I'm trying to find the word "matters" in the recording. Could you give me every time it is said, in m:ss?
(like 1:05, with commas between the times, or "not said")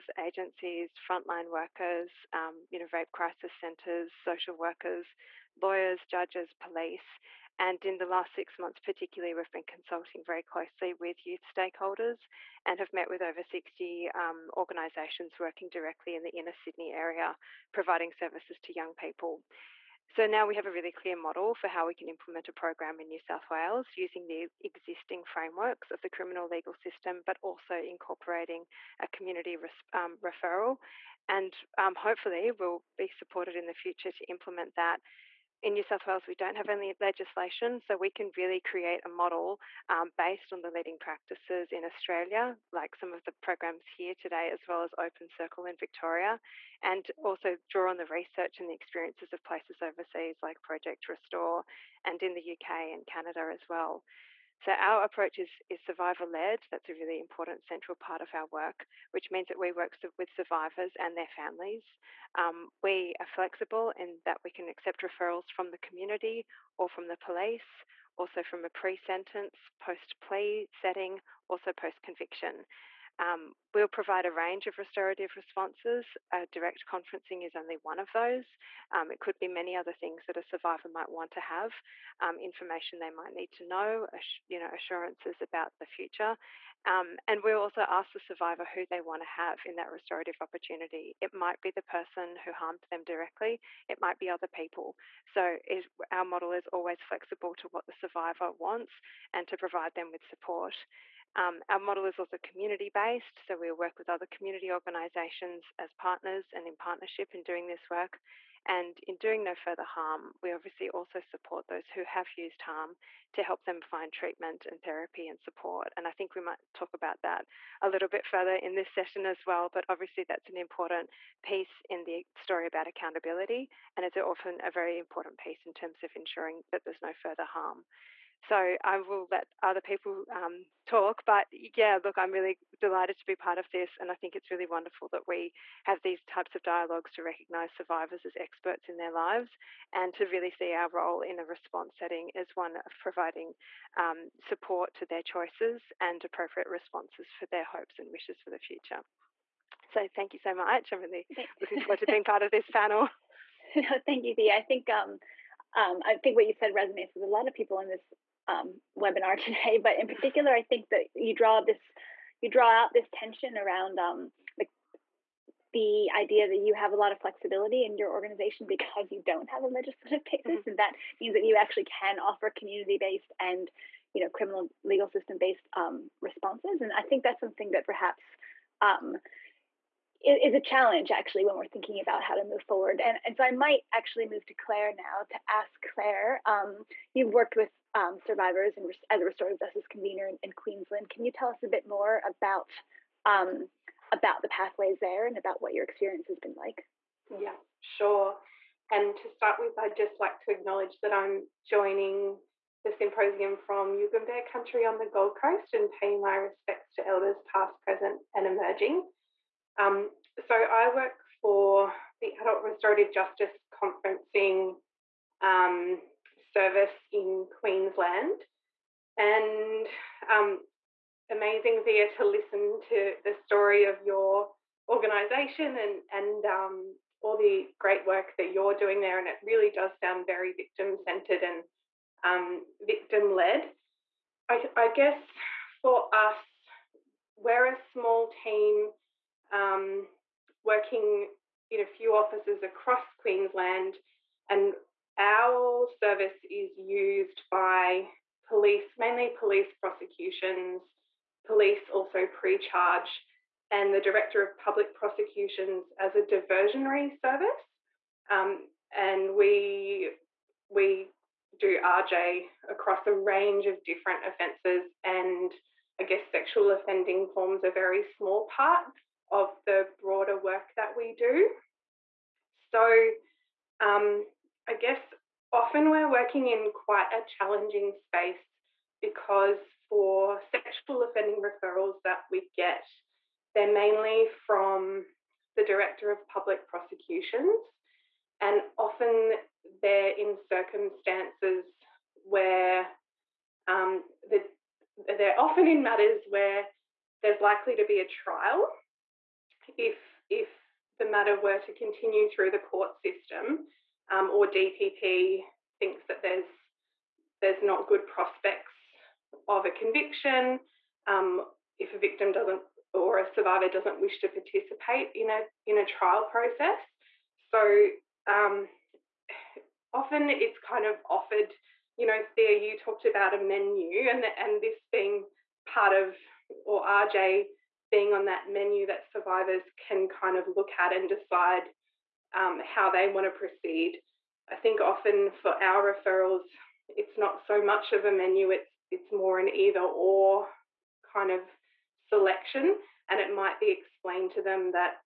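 4:55, 5:01.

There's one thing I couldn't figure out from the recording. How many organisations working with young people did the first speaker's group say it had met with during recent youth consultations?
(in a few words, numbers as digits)
over 60.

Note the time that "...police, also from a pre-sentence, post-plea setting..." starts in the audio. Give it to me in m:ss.
1:07.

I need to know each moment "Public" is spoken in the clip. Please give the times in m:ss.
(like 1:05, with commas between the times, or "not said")
4:14, 4:46.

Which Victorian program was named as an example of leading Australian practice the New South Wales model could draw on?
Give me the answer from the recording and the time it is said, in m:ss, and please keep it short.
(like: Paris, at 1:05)
Open Circle, at 0:44.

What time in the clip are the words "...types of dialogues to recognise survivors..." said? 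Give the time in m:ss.
2:16.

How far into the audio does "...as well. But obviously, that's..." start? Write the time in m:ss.
1:59.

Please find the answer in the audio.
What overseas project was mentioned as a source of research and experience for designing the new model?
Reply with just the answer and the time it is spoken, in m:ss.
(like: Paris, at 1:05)
Project Restore, at 0:50.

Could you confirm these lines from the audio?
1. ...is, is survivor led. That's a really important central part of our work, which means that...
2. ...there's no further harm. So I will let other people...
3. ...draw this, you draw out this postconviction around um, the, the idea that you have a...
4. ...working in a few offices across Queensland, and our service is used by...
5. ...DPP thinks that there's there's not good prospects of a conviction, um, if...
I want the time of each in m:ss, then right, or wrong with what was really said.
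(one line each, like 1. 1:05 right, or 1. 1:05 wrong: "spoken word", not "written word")
1. 0:55 right
2. 2:06 right
3. 2:41 wrong: "tension", not "postconviction"
4. 4:00 right
5. 5:04 right.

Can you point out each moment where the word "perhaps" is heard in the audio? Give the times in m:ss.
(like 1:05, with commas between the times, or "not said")
2:57.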